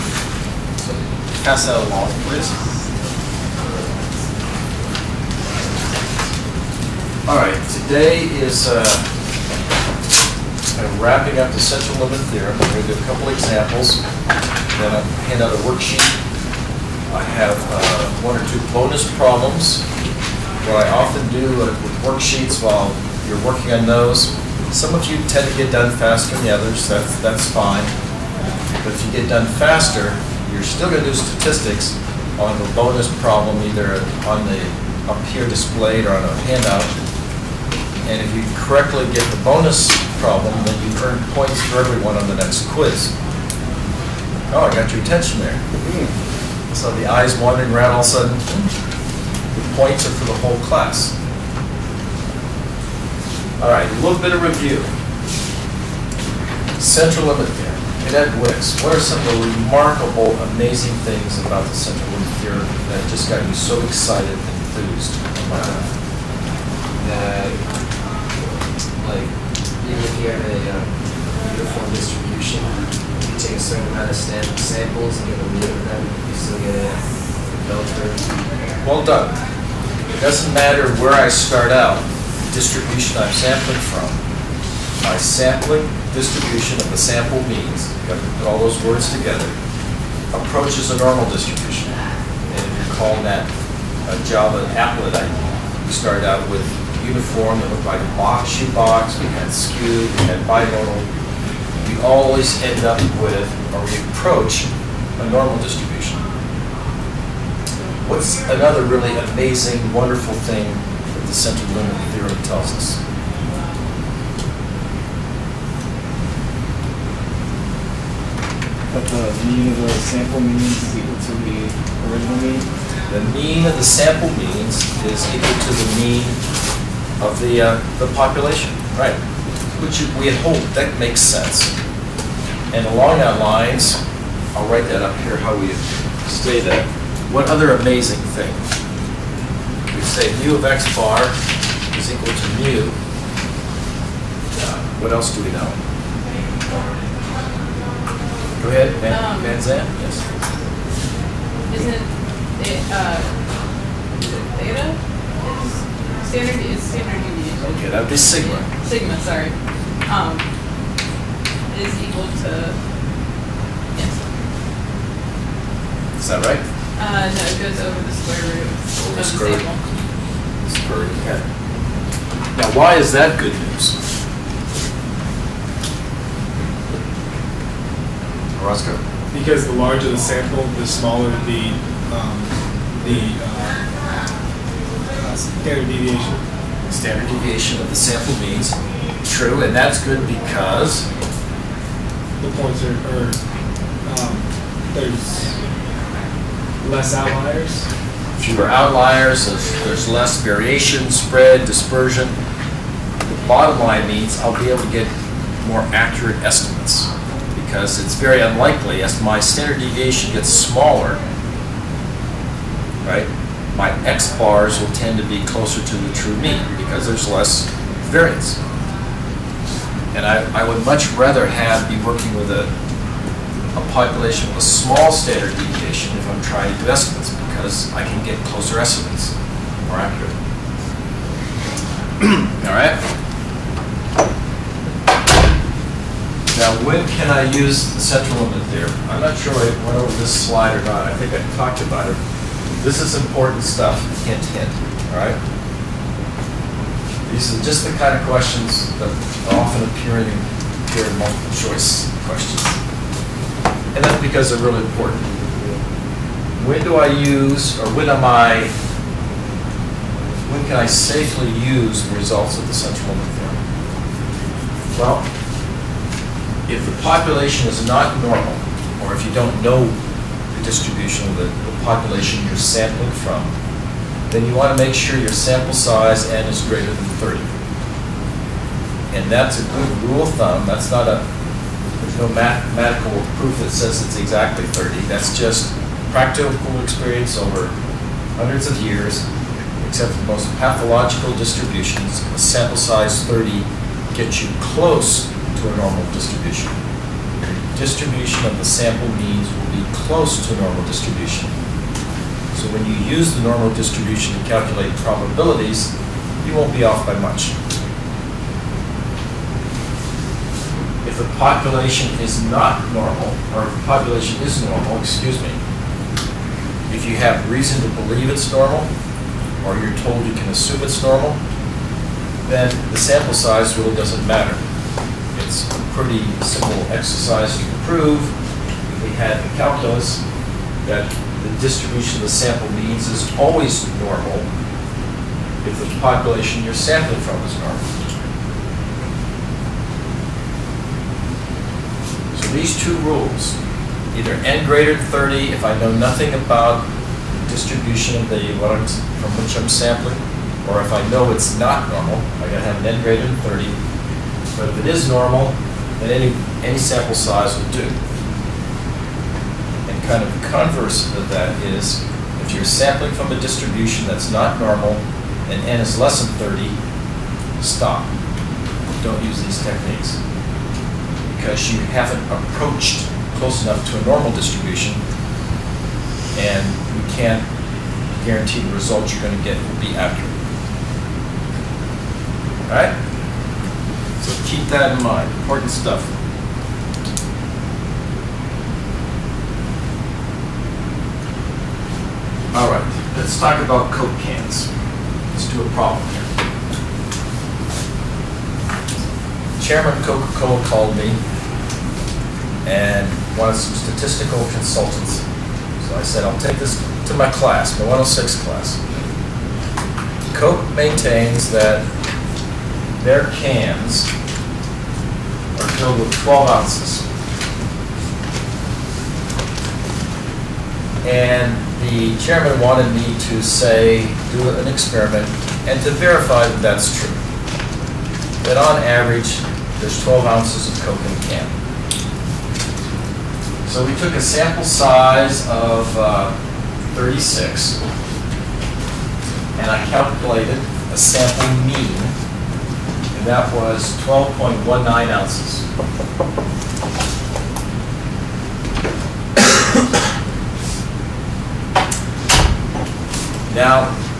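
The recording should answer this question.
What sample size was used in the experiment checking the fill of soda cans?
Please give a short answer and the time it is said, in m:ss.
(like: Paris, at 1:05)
36, at 7:16.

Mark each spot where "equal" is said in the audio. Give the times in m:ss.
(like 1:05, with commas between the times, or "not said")
2:00, 2:05, 2:22, 2:42.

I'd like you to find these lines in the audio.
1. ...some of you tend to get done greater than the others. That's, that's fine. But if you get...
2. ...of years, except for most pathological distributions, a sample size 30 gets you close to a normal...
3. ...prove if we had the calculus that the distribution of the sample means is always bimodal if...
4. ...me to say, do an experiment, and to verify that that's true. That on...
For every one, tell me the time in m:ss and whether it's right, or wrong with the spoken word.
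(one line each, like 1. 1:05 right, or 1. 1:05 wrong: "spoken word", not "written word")
1. 0:24 wrong: "faster", not "greater"
2. 4:48 right
3. 5:27 wrong: "normal", not "bimodal"
4. 7:02 right.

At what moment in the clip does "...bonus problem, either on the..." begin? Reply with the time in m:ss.
0:32.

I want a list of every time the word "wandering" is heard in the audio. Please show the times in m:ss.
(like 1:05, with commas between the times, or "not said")
0:47.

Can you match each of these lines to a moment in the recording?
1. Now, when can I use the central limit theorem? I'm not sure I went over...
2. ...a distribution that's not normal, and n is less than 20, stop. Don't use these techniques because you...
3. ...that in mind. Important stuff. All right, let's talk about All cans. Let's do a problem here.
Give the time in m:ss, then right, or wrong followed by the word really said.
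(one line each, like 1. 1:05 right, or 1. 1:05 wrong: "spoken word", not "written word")
1. 3:56 right
2. 6:03 wrong: "30", not "20"
3. 6:24 wrong: "Coke", not "All".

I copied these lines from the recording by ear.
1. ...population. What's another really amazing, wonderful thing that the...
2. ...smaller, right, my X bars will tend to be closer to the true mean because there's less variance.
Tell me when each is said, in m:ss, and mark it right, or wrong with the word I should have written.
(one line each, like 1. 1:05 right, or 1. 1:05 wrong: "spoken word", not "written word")
1. 1:45 wrong: "distribution", not "population"
2. 3:30 right.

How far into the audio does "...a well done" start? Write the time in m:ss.
1:16.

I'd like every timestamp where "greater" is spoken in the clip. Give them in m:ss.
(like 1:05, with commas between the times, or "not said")
4:36, 5:44, 5:53.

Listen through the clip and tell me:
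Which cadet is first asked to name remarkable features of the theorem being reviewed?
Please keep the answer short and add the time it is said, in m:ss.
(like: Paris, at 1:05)
Wicks, at 0:58.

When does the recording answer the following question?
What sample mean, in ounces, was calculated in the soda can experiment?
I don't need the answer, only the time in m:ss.
7:23.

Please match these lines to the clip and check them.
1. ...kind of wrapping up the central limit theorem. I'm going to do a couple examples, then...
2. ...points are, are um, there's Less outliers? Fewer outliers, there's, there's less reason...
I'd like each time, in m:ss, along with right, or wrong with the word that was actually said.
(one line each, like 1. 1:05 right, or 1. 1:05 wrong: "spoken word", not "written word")
1. 0:10 right
2. 3:12 wrong: "variation", not "reason".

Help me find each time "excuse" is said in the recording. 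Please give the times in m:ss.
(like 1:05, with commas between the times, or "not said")
5:15.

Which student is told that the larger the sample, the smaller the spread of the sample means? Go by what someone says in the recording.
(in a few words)
Roscoe.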